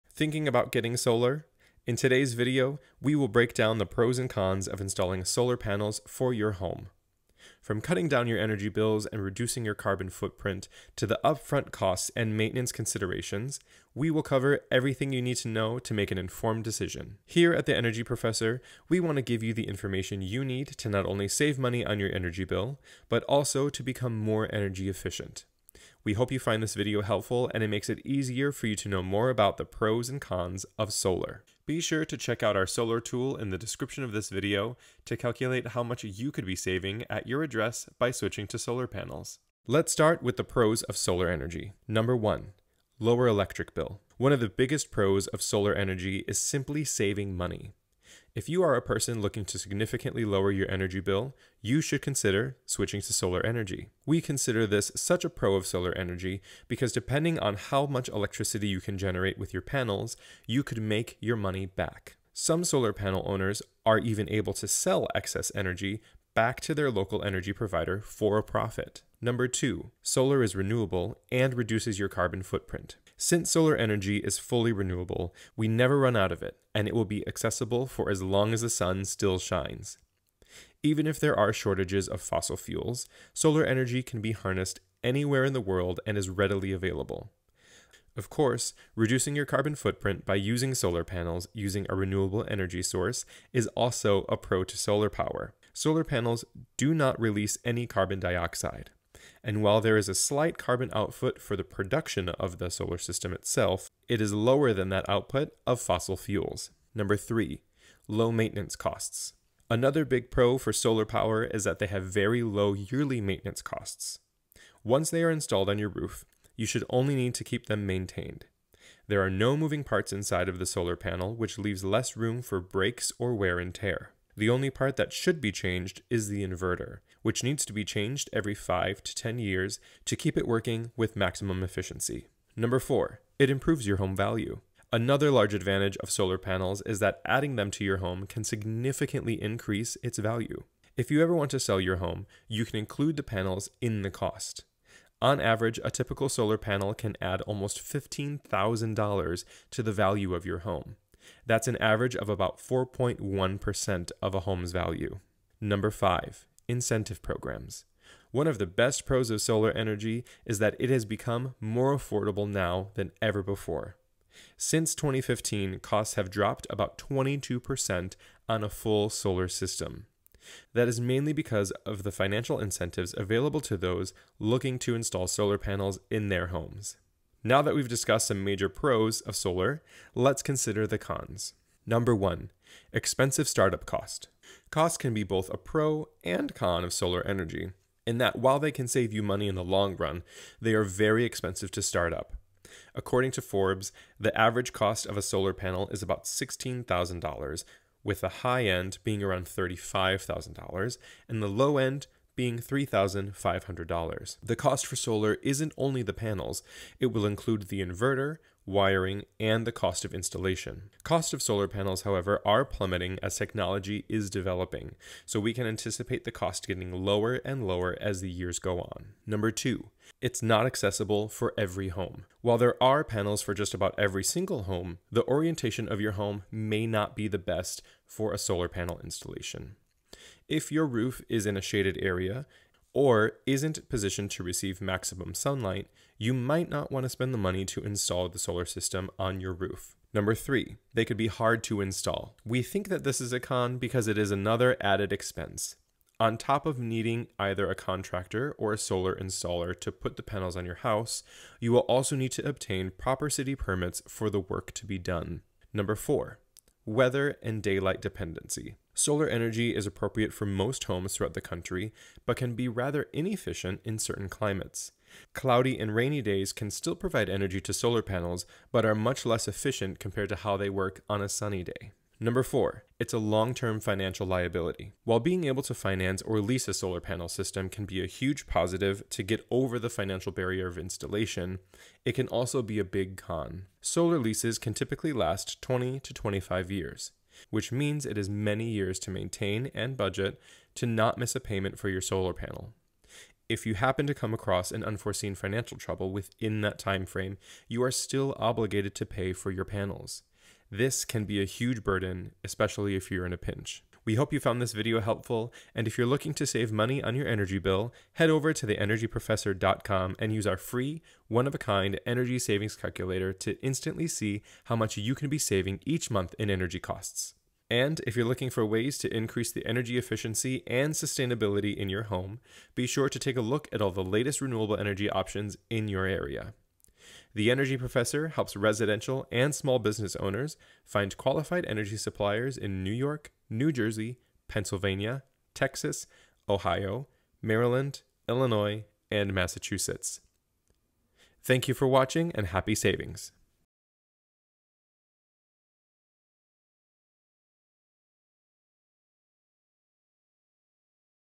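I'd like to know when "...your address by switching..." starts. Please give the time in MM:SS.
00:37.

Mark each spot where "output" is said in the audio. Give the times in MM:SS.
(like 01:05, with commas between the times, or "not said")
01:40, 01:45.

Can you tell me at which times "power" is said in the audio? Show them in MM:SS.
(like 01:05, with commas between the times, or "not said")
01:35, 01:51.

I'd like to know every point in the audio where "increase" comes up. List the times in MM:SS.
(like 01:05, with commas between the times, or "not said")
02:19, 05:19.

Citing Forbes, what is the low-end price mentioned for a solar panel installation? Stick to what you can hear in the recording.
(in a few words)
$3,500.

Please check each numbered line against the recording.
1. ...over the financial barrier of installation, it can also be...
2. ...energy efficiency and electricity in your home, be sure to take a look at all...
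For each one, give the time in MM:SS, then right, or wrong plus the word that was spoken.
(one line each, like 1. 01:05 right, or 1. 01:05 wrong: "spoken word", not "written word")
1. 04:39 right
2. 05:19 wrong: "sustainability", not "electricity".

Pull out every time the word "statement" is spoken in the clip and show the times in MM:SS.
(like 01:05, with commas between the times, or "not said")
not said.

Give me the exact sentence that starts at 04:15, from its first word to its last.
Number four, weather and daylight dependency.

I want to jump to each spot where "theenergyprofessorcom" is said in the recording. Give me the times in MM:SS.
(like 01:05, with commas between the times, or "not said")
05:08.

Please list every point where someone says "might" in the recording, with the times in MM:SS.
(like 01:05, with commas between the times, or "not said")
03:56.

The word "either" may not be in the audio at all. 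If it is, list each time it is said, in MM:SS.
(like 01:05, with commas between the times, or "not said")
04:07.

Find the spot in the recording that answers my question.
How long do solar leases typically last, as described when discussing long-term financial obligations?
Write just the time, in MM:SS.
04:45.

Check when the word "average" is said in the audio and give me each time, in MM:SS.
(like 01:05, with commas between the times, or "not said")
02:25, 02:31, 03:14.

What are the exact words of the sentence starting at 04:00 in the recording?
Number three, they could be hard to install.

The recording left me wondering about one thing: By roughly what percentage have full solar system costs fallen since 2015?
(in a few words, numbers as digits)
22%.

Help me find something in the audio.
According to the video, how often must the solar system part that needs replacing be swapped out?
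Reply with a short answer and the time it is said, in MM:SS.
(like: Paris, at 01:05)
every 5 to 10 years, at 02:08.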